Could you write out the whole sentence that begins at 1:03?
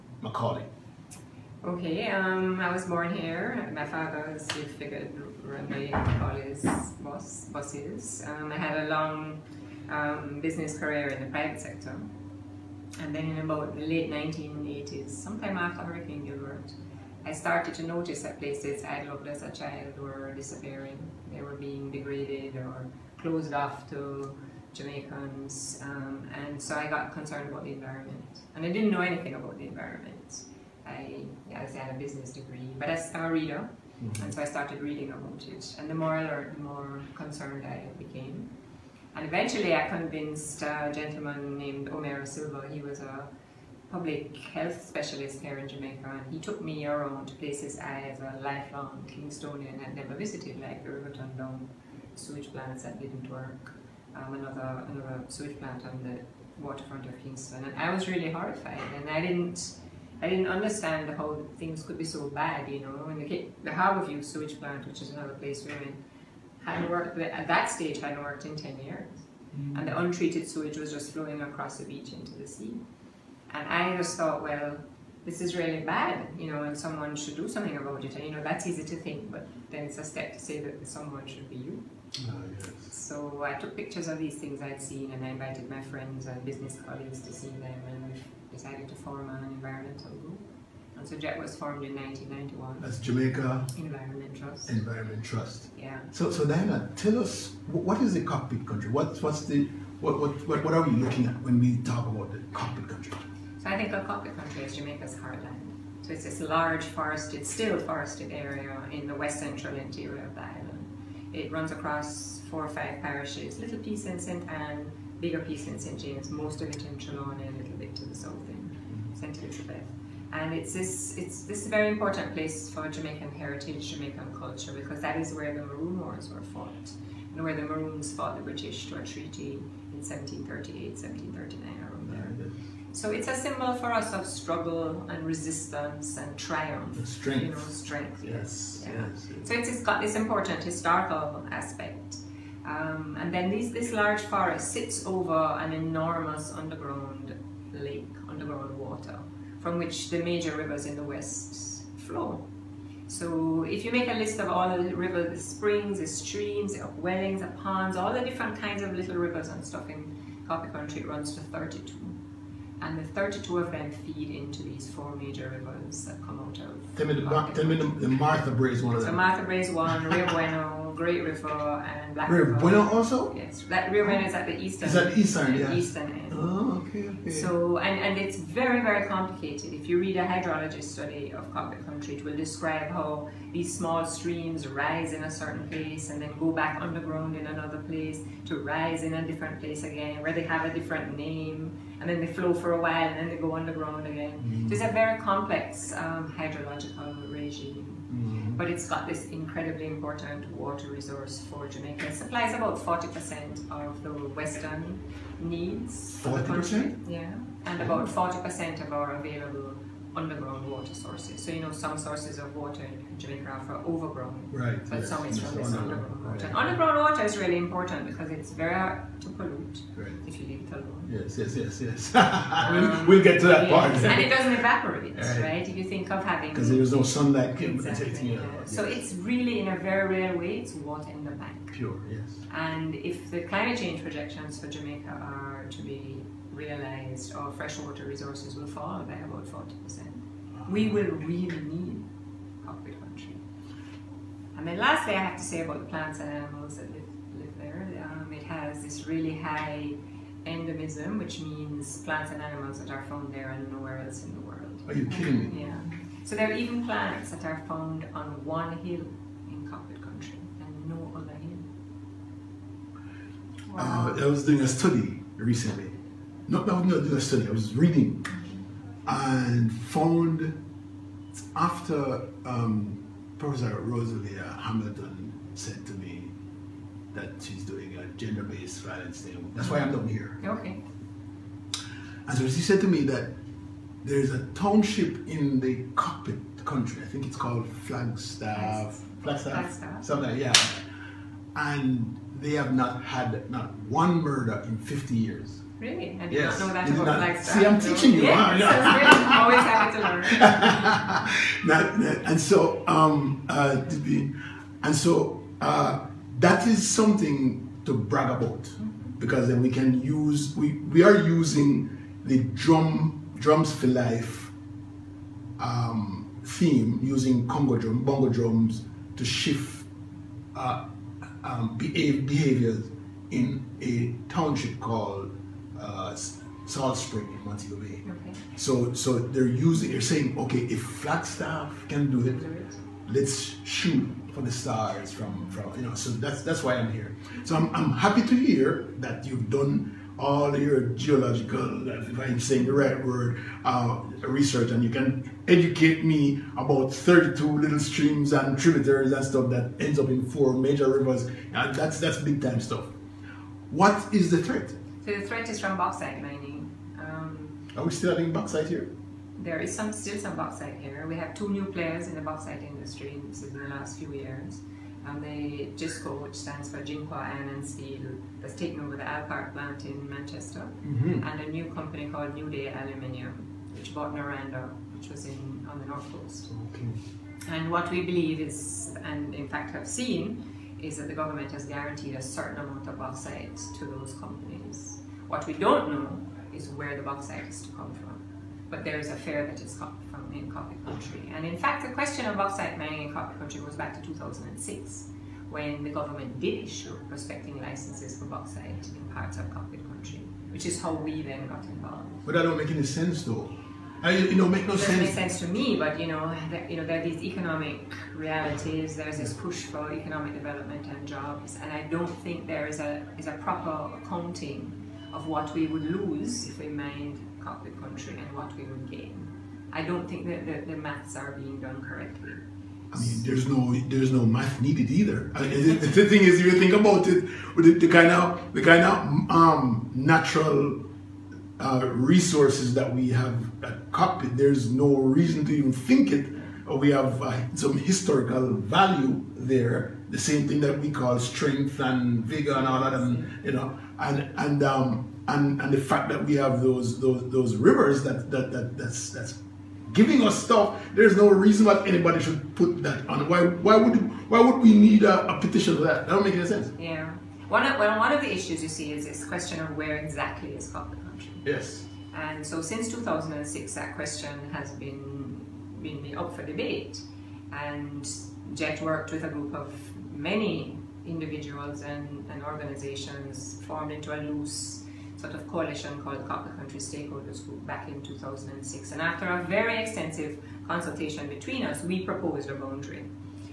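And the, the View sewage plant, which is another place women hadn't worked at that stage, hadn't worked in ten years, mm.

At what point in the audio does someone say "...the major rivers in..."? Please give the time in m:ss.
2:30.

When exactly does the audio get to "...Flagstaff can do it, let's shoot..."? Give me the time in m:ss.
5:30.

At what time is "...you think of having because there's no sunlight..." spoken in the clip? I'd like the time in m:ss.
3:45.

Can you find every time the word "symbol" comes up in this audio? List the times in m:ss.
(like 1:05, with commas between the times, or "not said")
2:13.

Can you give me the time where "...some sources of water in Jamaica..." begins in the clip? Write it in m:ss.
3:31.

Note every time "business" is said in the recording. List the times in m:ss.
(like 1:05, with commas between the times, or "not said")
0:10, 0:31, 1:26.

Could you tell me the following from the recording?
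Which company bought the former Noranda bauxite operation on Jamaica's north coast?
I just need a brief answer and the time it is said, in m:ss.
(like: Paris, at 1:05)
New Day Aluminium, at 6:12.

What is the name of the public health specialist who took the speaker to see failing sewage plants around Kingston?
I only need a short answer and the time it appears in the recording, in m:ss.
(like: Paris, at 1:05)
Omer Silva, at 0:41.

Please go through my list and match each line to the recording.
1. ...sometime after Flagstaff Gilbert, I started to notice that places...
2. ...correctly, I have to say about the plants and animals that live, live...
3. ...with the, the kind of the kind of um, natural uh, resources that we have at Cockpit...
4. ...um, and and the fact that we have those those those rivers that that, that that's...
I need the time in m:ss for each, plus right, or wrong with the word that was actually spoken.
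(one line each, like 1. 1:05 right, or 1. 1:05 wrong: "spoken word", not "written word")
1. 0:15 wrong: "Hurricane", not "Flagstaff"
2. 4:04 wrong: "lastly", not "correctly"
3. 7:07 right
4. 7:24 right.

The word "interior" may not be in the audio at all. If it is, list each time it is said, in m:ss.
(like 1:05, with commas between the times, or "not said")
1:49.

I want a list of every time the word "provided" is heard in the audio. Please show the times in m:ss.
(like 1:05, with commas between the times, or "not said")
not said.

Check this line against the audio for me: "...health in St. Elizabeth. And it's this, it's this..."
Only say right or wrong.
wrong.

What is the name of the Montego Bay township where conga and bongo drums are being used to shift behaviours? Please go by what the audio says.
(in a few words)
Salt Spring.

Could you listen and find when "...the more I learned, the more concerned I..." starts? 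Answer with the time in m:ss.
0:35.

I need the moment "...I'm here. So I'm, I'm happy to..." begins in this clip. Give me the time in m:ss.
5:36.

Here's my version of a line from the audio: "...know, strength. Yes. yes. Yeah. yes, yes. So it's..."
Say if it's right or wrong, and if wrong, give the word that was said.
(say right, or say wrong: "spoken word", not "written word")
right.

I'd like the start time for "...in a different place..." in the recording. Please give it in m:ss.
3:09.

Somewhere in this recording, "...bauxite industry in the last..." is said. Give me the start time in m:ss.
6:02.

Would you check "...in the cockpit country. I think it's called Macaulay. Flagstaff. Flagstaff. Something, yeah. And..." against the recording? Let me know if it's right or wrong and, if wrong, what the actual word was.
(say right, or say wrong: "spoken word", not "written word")
wrong: "Flagstaff", not "Macaulay".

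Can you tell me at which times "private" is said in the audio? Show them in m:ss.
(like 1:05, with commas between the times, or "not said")
0:11.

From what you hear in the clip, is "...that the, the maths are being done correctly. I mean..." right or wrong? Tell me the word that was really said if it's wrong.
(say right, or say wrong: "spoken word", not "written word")
right.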